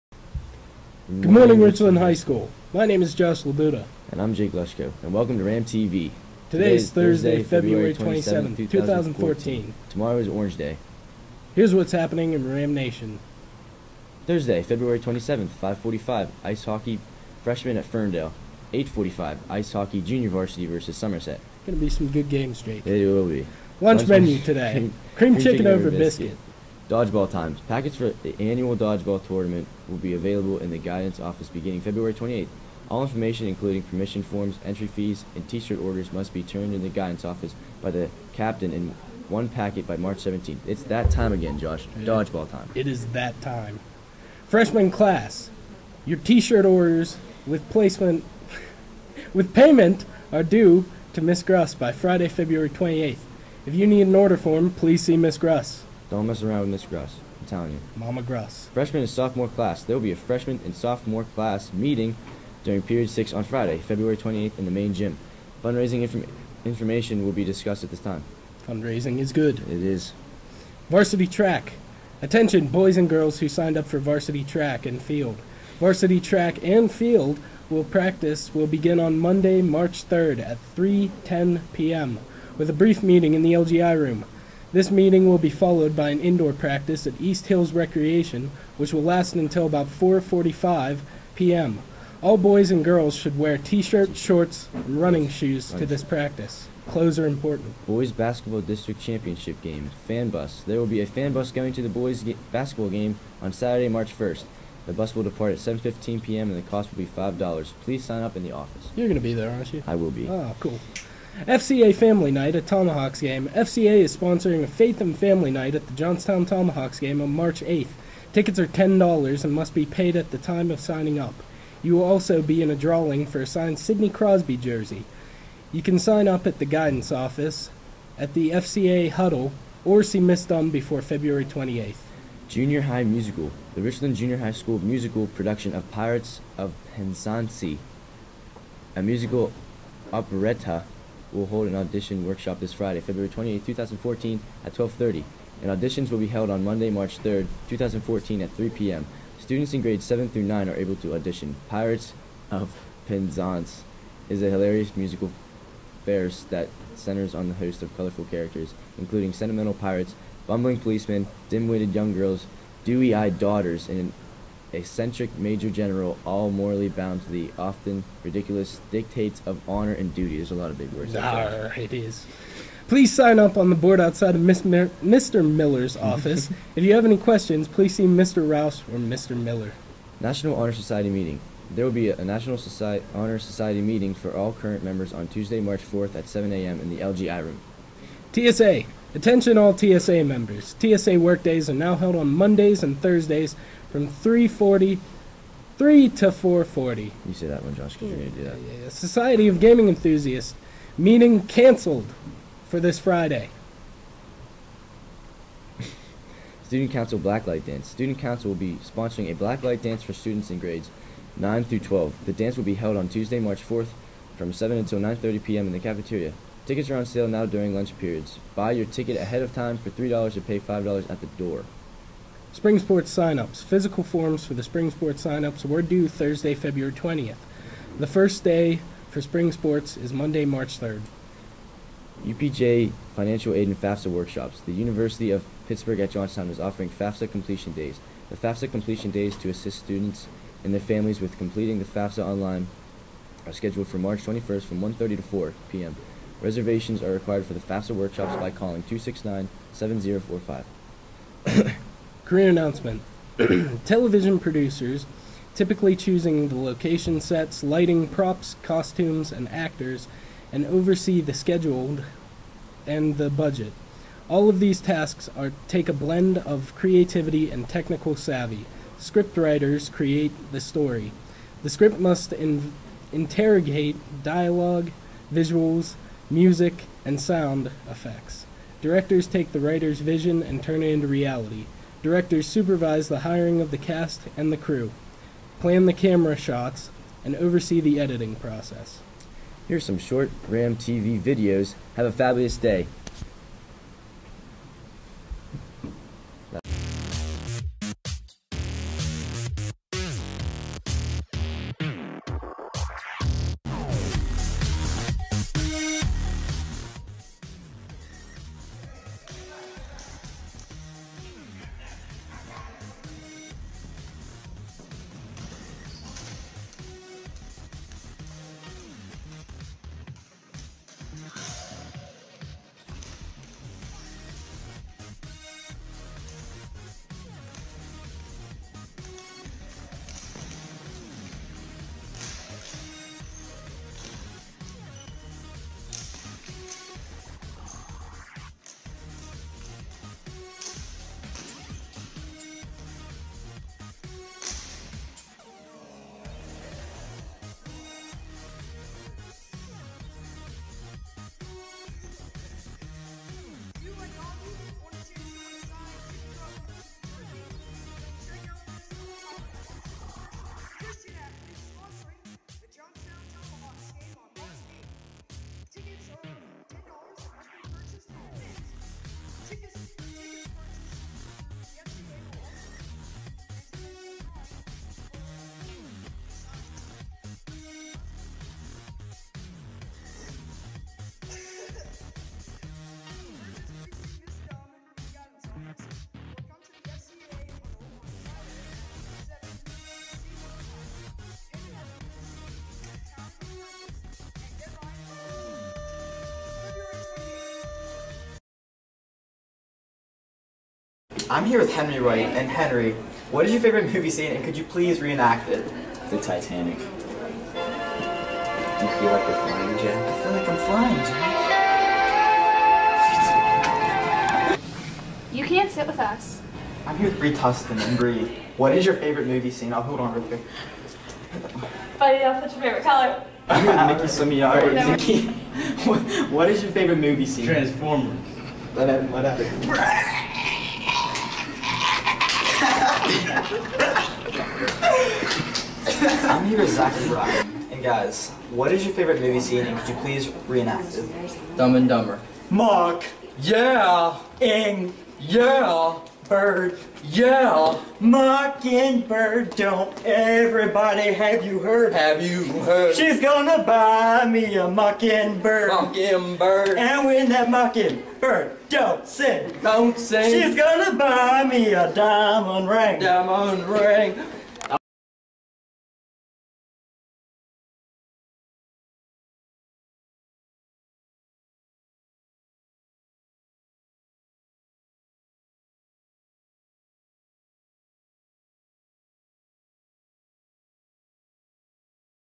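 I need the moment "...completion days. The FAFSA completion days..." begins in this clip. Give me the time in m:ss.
3:57.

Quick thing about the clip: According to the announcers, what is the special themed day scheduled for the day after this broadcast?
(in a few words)
Orange Day.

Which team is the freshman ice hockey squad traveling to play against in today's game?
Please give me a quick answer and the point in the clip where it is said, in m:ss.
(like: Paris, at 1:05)
Ferndale, at 0:17.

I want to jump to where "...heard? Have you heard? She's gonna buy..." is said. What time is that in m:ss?
7:31.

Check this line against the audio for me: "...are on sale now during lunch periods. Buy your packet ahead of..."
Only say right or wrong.
wrong.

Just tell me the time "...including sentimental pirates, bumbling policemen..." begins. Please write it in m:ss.
2:38.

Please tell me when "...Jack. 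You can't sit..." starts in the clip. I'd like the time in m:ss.
6:54.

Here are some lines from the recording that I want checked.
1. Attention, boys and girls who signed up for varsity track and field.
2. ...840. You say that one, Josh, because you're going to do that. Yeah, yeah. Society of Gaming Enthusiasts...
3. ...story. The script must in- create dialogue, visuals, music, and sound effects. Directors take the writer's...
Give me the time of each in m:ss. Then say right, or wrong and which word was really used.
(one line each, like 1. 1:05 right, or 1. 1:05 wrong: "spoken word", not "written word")
1. 1:12 right
2. 3:16 wrong: "440", not "840"
3. 4:30 wrong: "interrogate", not "create".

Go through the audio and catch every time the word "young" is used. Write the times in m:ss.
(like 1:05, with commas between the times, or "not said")
2:41.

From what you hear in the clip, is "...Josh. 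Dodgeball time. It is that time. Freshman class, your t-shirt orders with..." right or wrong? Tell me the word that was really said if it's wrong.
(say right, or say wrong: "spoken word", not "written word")
right.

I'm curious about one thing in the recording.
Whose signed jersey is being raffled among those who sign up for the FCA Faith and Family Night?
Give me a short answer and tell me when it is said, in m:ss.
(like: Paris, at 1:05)
Sidney Crosby, at 2:03.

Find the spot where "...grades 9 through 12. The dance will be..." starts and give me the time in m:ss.
3:30.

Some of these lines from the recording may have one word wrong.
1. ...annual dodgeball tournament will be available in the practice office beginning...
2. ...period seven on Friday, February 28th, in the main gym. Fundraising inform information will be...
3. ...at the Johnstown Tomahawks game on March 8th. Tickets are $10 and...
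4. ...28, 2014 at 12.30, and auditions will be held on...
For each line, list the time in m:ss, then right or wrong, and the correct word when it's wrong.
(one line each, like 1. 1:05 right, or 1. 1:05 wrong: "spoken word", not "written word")
1. 0:28 wrong: "guidance", not "practice"
2. 1:02 wrong: "six", not "seven"
3. 1:55 right
4. 2:23 right.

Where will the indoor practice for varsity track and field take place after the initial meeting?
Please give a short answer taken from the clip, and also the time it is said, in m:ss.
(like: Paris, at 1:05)
East Hills Recreation, at 1:27.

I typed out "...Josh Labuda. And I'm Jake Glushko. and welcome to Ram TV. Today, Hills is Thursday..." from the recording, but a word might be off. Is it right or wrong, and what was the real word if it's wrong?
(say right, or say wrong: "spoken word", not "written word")
wrong: "Today", not "Hills".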